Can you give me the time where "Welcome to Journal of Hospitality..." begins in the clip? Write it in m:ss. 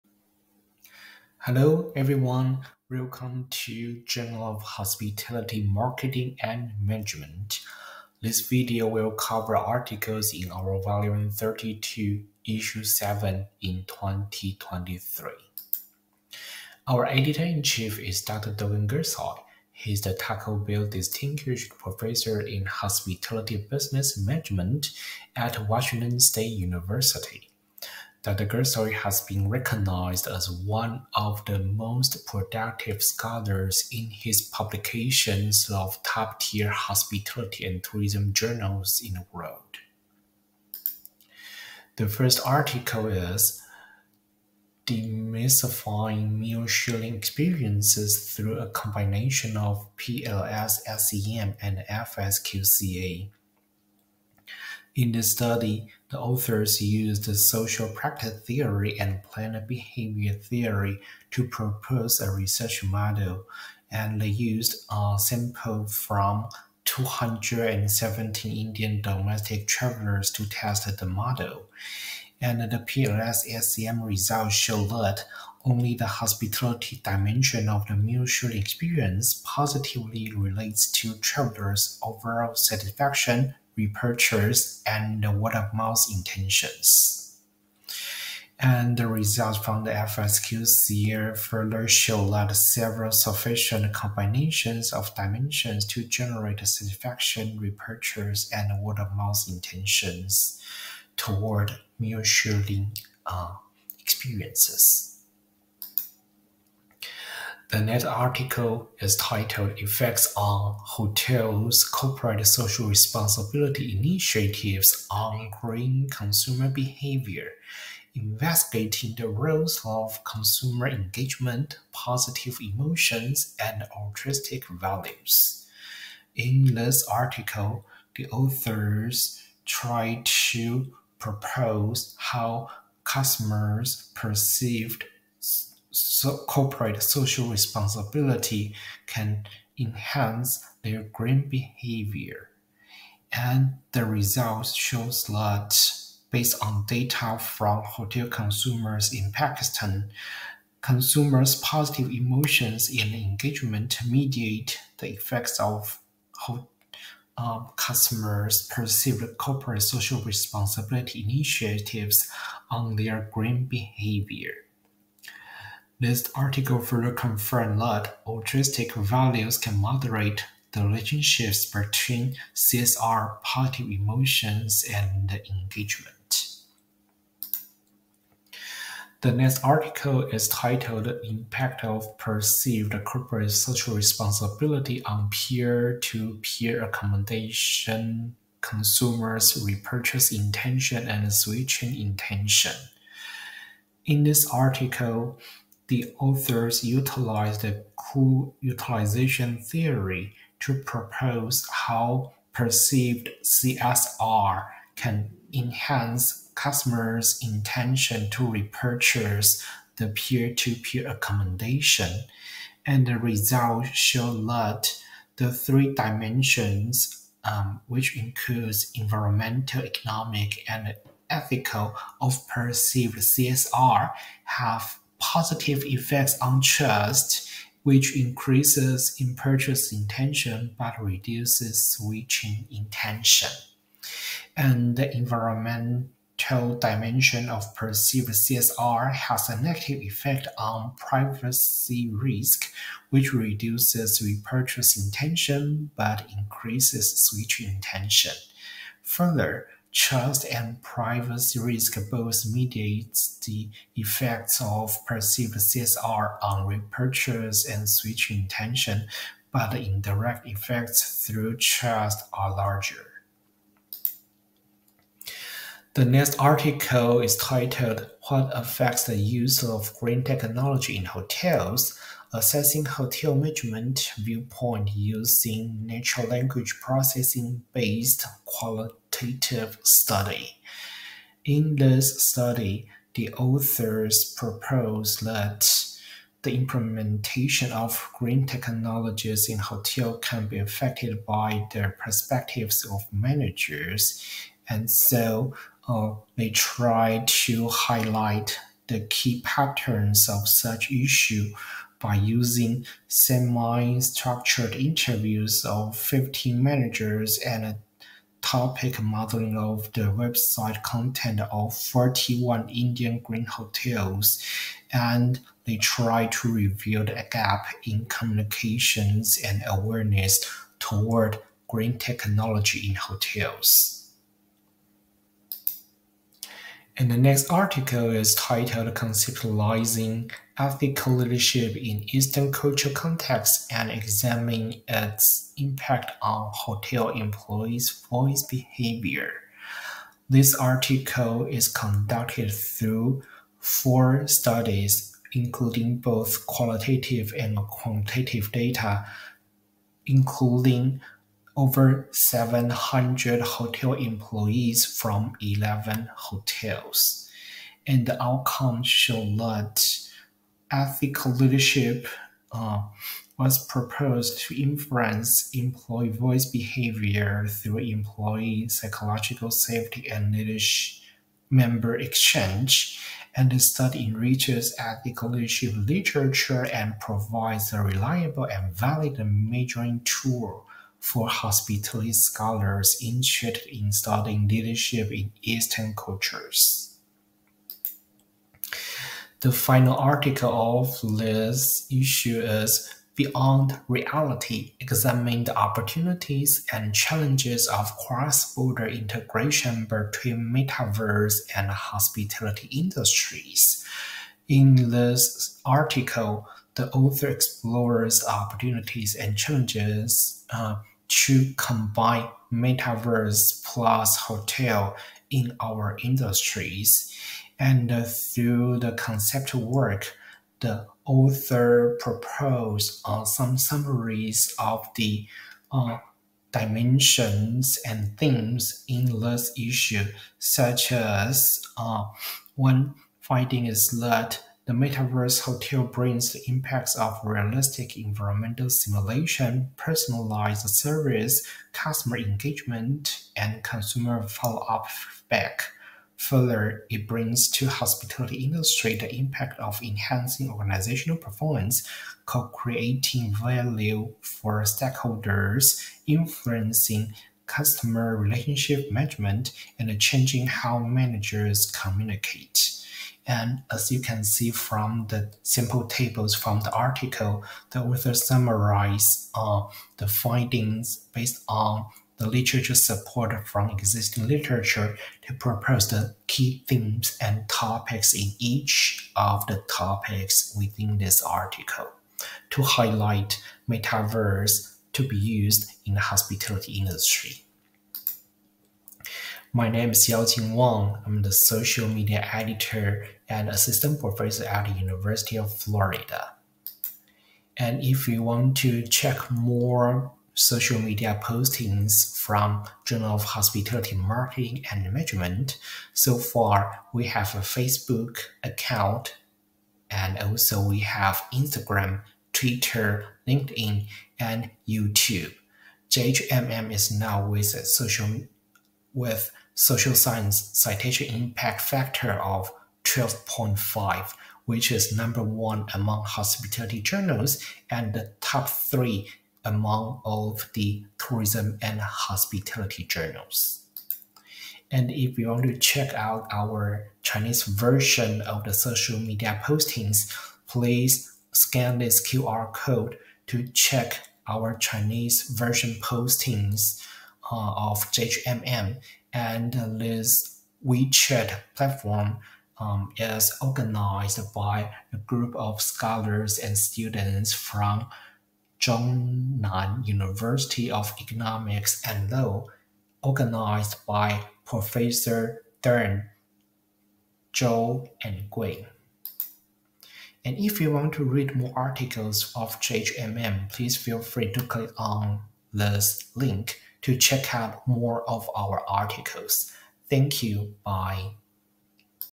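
0:02.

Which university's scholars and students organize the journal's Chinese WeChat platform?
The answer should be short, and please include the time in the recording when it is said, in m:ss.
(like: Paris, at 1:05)
Zhongnan University of Economics and Law, at 9:18.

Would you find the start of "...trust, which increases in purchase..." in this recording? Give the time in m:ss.
3:46.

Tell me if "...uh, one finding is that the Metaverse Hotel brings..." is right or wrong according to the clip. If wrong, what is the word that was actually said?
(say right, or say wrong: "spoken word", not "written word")
right.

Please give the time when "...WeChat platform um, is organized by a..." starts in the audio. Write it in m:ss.
9:10.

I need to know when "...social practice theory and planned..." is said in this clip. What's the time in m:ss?
0:57.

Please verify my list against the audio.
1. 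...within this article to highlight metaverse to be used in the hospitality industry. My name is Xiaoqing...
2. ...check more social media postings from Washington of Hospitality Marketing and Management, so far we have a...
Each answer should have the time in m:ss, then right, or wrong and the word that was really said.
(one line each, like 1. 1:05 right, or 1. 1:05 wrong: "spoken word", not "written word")
1. 8:00 right
2. 8:18 wrong: "Journal", not "Washington".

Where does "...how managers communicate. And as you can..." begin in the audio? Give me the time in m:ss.
7:40.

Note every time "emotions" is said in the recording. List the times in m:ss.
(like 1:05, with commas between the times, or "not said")
2:02, 2:32, 2:53.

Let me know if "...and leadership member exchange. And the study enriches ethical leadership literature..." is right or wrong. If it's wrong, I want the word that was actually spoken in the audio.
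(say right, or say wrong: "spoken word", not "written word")
right.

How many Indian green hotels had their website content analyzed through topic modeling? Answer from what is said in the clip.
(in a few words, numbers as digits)
41.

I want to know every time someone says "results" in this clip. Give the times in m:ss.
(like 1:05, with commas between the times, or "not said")
1:14, 1:29, 2:24, 3:33.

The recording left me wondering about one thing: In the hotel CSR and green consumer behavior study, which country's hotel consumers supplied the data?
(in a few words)
Pakistan.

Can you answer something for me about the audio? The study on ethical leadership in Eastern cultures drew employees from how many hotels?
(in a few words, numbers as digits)
11.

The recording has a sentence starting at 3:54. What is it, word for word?
And the environmental dimension of perceived CSR has a negative effect on privacy risk, which reduces repurchase intention but increases switching intention.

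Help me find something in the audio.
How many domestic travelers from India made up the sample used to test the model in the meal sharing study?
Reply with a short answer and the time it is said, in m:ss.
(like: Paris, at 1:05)
217, at 1:06.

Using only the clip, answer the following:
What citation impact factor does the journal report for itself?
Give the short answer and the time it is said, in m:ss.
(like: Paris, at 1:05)
12.5, at 8:42.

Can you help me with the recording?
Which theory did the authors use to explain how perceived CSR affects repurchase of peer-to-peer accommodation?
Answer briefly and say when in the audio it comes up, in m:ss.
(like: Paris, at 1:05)
Cue utilization theory, at 3:18.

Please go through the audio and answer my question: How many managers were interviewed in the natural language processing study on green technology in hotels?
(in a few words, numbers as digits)
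15.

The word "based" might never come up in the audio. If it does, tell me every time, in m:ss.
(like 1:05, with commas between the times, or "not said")
2:26, 4:37, 7:51.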